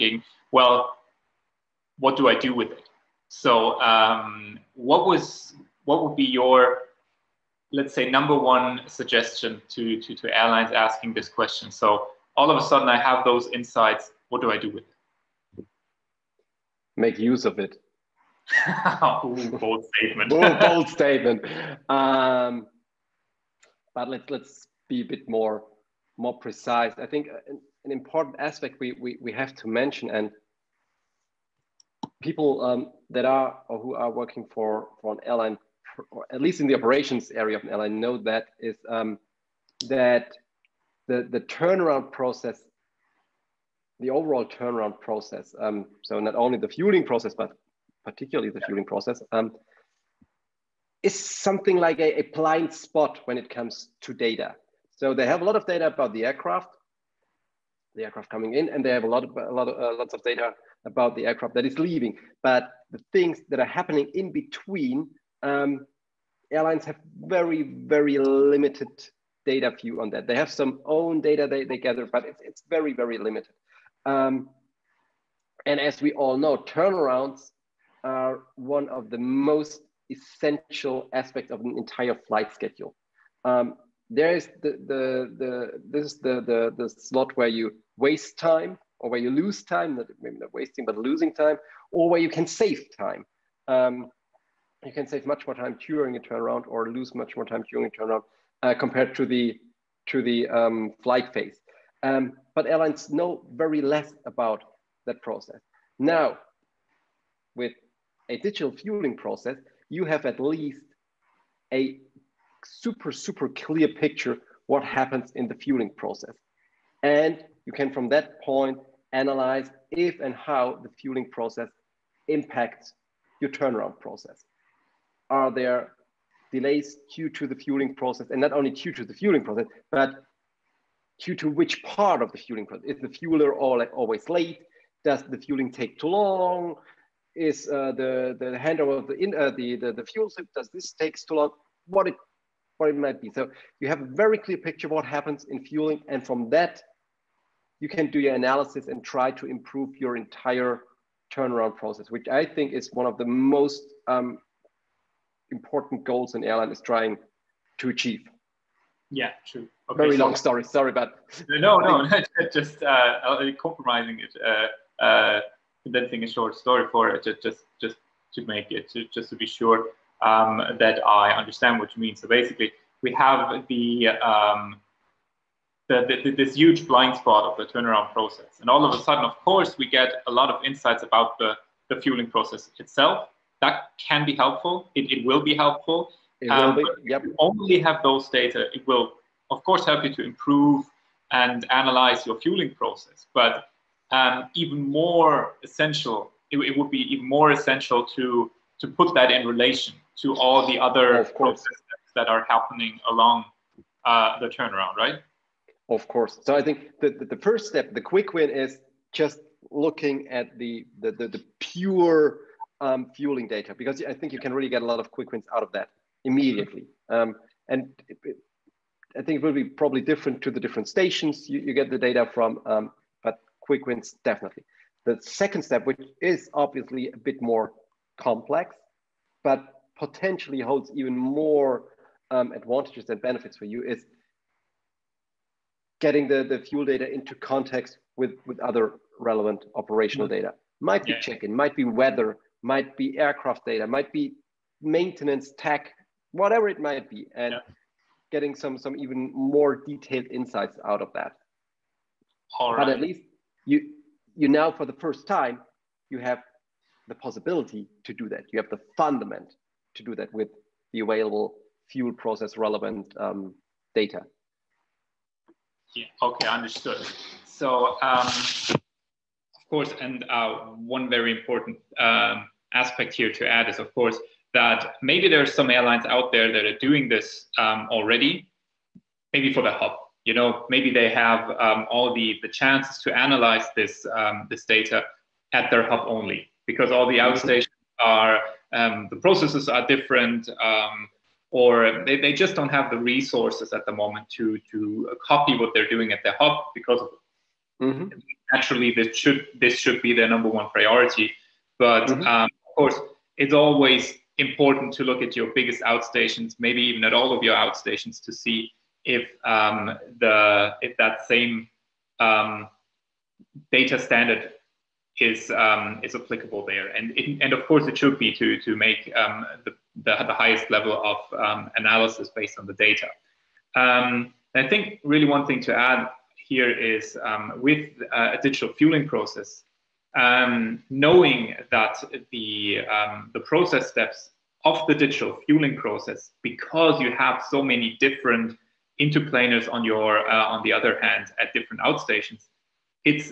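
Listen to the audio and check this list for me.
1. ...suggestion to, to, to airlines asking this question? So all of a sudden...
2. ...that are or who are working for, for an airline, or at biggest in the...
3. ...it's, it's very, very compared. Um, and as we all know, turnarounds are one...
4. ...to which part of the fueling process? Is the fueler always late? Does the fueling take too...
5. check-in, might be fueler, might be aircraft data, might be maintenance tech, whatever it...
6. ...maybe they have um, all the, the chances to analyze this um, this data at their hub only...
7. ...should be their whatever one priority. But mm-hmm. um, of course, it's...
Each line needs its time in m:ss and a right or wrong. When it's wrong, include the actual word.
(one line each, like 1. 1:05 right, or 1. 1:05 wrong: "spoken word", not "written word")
1. 0:08 right
2. 0:33 wrong: "least", not "biggest"
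3. 1:12 wrong: "limited", not "compared"
4. 2:11 right
5. 4:01 wrong: "weather", not "fueler"
6. 4:40 right
7. 4:59 wrong: "number", not "whatever".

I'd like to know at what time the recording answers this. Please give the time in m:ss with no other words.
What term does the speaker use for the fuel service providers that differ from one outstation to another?
5:38.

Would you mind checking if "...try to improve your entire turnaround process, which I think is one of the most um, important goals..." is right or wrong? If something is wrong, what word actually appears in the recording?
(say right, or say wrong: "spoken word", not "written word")
right.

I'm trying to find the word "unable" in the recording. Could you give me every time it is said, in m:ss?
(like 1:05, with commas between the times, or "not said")
not said.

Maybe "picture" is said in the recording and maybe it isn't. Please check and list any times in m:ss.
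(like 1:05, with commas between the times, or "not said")
1:53, 2:24.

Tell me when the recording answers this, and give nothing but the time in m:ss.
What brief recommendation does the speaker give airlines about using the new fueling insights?
0:16.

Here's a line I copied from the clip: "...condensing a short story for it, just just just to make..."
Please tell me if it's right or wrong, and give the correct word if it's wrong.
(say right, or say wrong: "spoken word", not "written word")
right.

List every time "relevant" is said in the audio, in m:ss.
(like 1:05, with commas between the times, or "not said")
3:59, 4:22.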